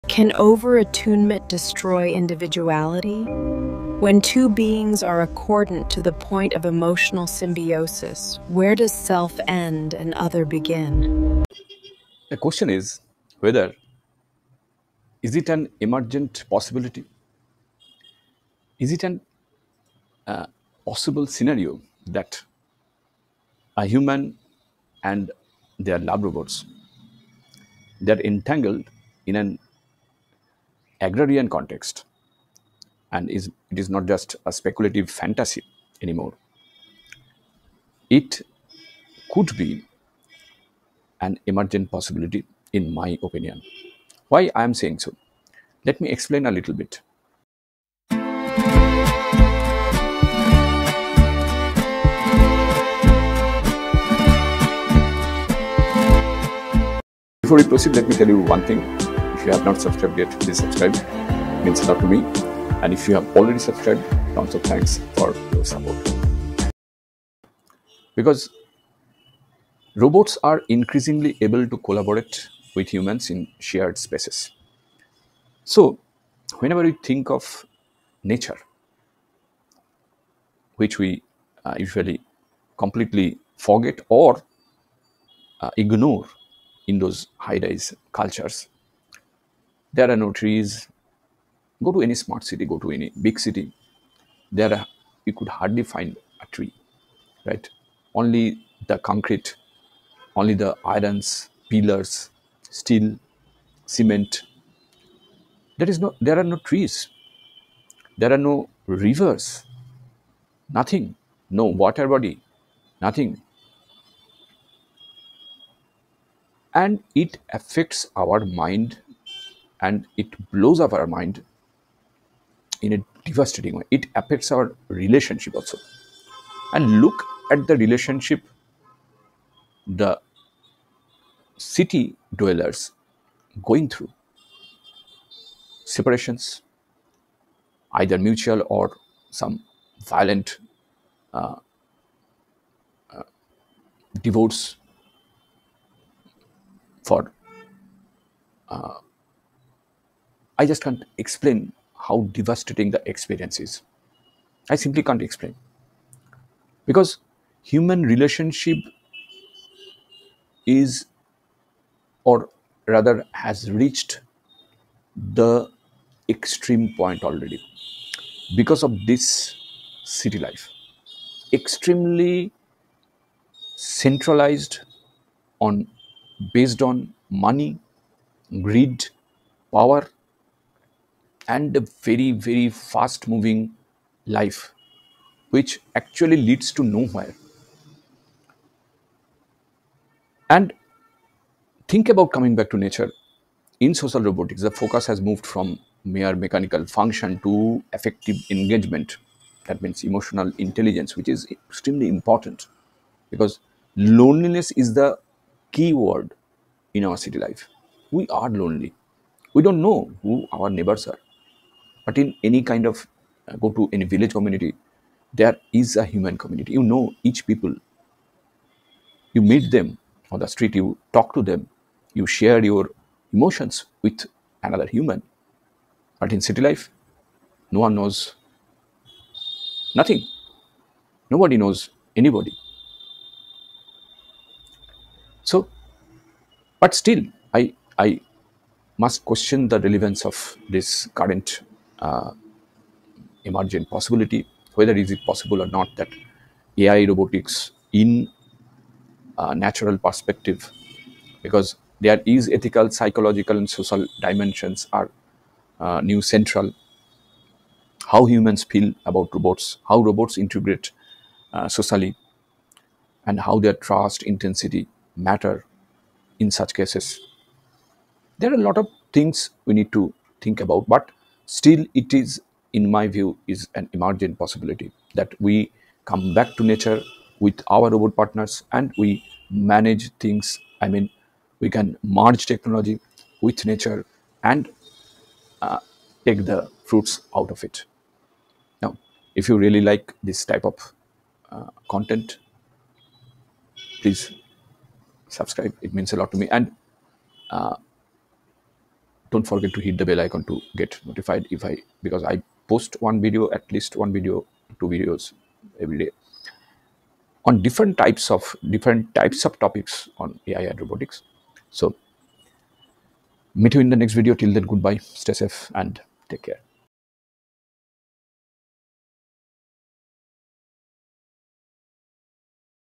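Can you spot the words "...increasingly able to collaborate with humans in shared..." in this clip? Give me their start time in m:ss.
1:10.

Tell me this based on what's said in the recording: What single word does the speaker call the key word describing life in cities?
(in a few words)
loneliness.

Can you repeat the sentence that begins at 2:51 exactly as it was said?
Extremely centralized on based on money, greed, power, and a very, very fast moving life, which actually leads to nowhere.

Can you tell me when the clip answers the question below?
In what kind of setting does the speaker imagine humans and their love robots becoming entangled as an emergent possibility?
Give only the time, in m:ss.
0:31.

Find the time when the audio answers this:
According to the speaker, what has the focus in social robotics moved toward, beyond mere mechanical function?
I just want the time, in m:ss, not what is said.
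3:17.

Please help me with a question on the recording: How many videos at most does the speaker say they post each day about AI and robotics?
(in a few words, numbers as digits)
2.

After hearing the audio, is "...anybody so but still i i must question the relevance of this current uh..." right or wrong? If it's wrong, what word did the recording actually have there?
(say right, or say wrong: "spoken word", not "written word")
right.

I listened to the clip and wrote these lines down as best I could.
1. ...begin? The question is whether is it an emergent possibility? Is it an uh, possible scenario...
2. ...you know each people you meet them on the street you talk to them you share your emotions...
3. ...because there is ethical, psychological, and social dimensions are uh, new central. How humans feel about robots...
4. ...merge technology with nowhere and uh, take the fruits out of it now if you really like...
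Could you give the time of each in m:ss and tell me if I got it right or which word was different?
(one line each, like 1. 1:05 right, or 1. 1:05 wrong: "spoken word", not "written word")
1. 0:10 right
2. 3:36 right
3. 4:11 right
4. 4:42 wrong: "nature", not "nowhere".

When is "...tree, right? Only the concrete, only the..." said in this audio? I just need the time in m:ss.
1:36.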